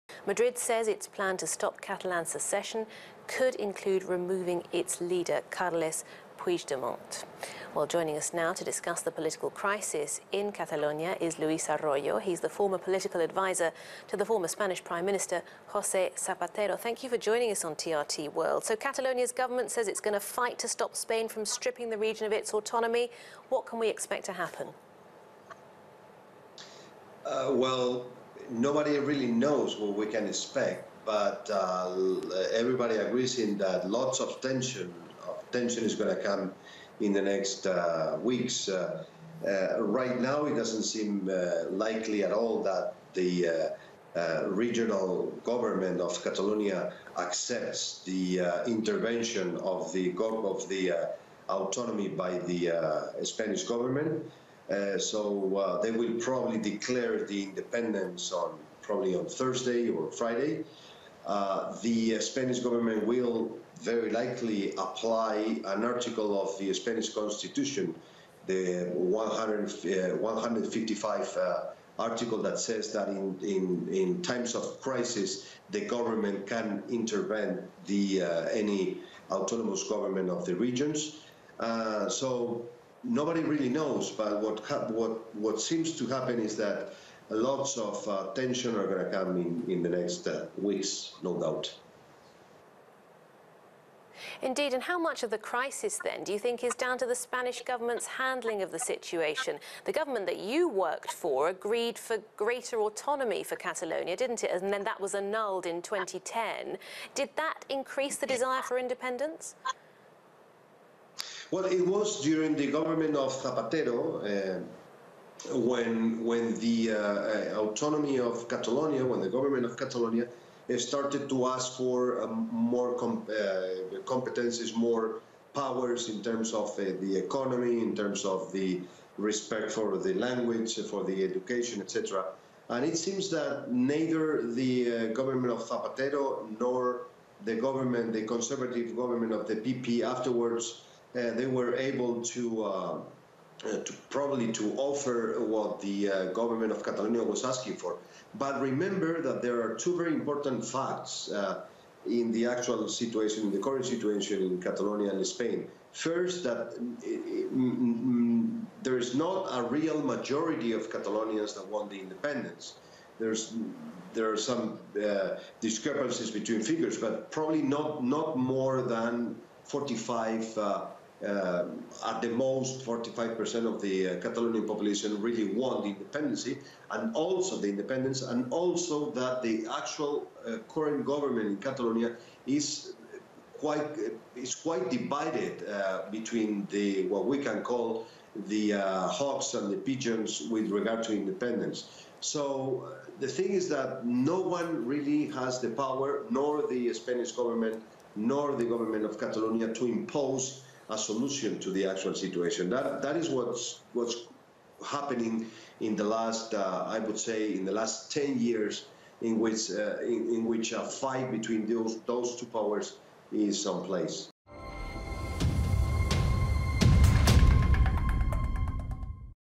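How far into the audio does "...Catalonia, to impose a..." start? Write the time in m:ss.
3:19.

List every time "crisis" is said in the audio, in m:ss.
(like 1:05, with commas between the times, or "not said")
0:09, 1:14, 1:35.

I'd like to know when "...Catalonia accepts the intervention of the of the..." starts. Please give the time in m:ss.
0:46.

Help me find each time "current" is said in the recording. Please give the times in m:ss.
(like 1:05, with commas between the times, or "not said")
2:33, 3:00.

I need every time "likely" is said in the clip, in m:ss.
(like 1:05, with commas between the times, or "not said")
0:41, 1:04.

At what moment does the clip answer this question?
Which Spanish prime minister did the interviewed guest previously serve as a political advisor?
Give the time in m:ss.
0:15.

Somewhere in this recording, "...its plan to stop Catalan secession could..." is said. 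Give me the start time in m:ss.
0:00.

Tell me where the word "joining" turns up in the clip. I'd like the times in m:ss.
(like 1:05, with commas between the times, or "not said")
0:07, 0:17.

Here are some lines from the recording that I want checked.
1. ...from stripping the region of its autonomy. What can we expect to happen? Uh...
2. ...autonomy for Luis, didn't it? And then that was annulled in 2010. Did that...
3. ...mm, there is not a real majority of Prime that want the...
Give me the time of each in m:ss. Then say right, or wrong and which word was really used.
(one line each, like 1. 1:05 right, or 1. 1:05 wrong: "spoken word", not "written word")
1. 0:21 right
2. 1:42 wrong: "Catalonia", not "Luis"
3. 2:38 wrong: "Catalonians", not "Prime".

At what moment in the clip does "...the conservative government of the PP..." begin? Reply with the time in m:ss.
2:18.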